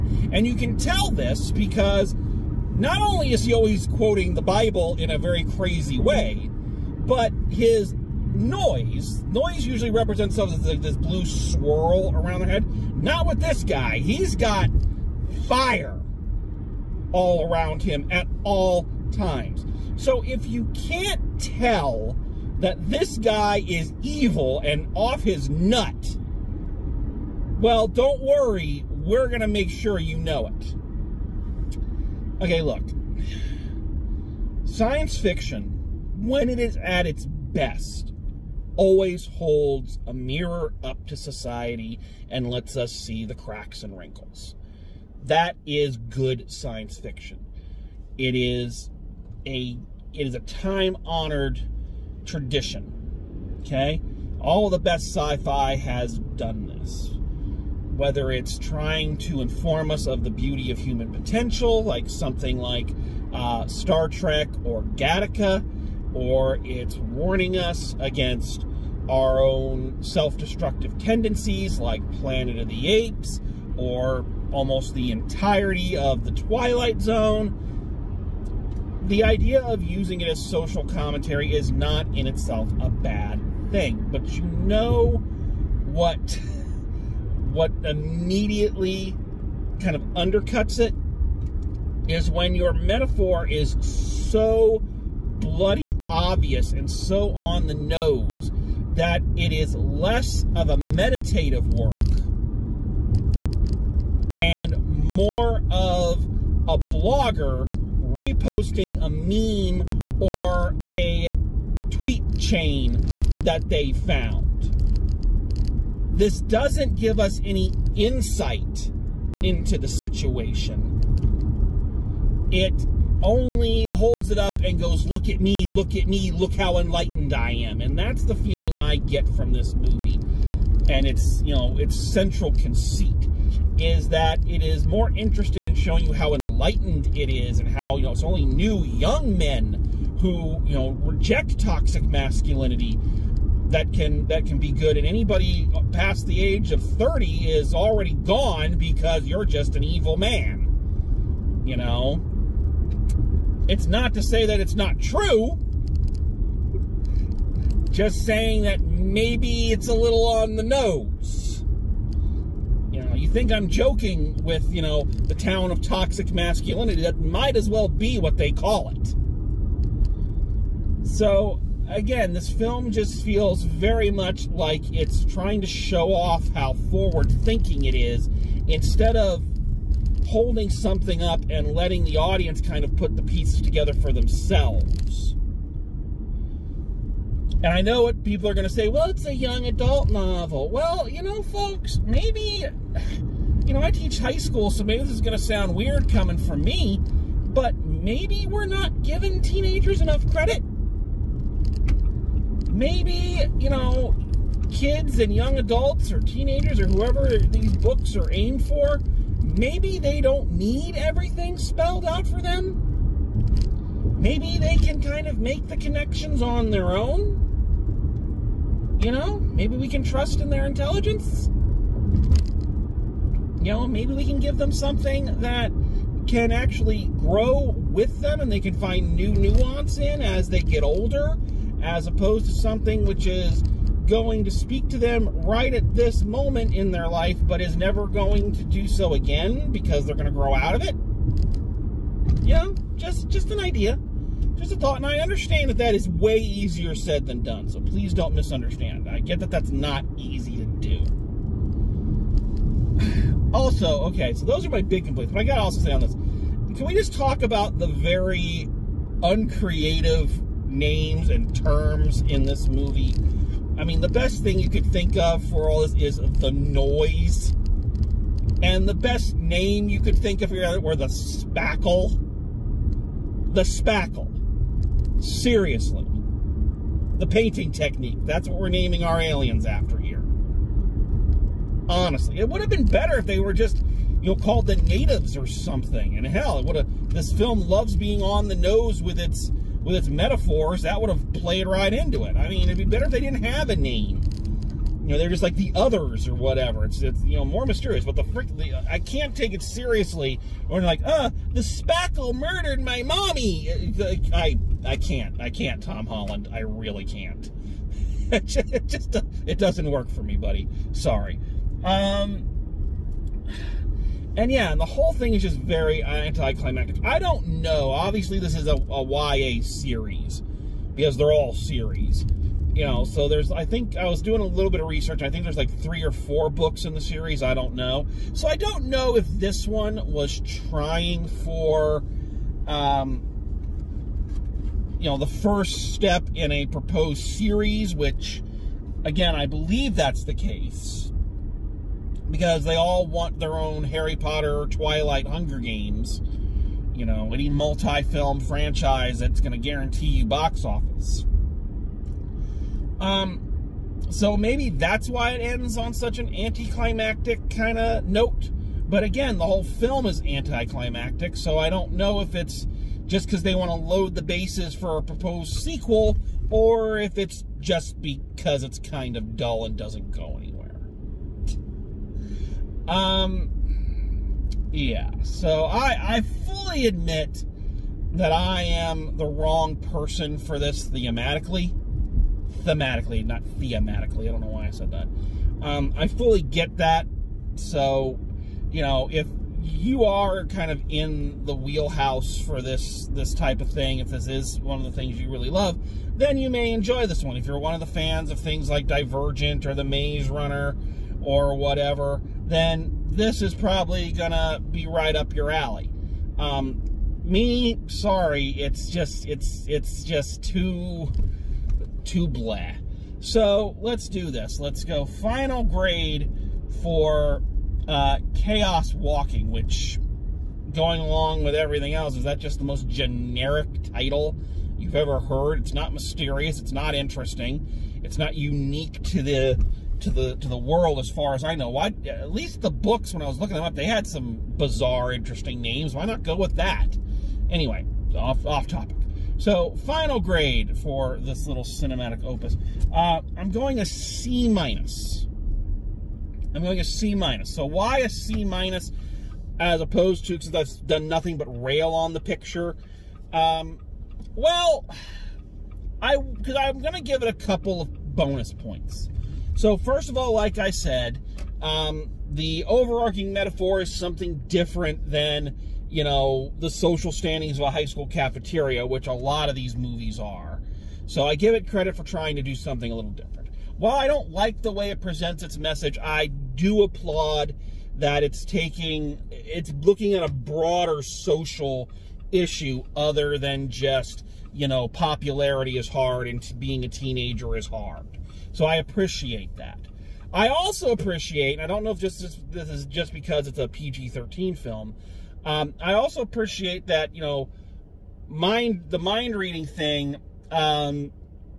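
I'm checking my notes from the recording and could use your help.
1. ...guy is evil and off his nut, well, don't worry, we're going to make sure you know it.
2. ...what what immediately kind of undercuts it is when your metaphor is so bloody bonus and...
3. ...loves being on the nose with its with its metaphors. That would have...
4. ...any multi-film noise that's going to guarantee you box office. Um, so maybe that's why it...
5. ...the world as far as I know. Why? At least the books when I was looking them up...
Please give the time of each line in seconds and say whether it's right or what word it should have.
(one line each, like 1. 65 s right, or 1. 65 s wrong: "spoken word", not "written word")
1. 23 s right
2. 85 s wrong: "obvious", not "bonus"
3. 287 s right
4. 347 s wrong: "franchise", not "noise"
5. 430 s right.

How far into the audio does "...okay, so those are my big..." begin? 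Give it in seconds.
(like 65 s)
254 s.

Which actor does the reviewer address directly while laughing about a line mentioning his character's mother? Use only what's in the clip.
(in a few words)
Tom Holland.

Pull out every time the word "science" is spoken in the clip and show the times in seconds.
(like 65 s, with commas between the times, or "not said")
34 s, 46 s.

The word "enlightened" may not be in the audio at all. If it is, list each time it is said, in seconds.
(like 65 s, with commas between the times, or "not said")
126 s, 136 s.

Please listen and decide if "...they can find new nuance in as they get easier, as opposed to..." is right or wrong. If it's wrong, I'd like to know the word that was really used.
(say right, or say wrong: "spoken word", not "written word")
wrong: "older", not "easier".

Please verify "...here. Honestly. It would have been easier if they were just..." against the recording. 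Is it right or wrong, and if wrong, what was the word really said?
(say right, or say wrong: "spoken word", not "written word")
wrong: "better", not "easier".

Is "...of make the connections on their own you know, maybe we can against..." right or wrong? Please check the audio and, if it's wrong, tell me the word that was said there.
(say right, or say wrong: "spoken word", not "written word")
wrong: "trust", not "against".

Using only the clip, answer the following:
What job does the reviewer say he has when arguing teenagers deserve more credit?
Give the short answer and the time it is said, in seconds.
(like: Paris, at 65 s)
Teach high school, at 193 s.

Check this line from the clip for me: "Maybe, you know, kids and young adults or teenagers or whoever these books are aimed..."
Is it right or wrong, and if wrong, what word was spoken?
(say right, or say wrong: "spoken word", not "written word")
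right.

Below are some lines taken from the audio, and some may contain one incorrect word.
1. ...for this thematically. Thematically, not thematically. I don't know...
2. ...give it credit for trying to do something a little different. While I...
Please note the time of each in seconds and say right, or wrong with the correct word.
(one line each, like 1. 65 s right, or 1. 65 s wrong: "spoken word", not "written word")
1. 380 s right
2. 471 s right.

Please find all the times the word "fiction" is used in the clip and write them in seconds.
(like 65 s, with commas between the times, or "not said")
35 s, 46 s.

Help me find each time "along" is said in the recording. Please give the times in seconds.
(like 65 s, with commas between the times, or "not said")
420 s.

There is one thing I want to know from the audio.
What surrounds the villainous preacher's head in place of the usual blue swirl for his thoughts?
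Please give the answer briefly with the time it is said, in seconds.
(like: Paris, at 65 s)
Fire, at 15 s.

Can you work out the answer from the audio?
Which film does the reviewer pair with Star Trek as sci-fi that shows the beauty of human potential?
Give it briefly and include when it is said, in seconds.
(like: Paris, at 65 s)
Gattaca, at 64 s.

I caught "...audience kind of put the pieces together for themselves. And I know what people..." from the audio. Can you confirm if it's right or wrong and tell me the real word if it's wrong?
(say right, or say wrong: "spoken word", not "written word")
right.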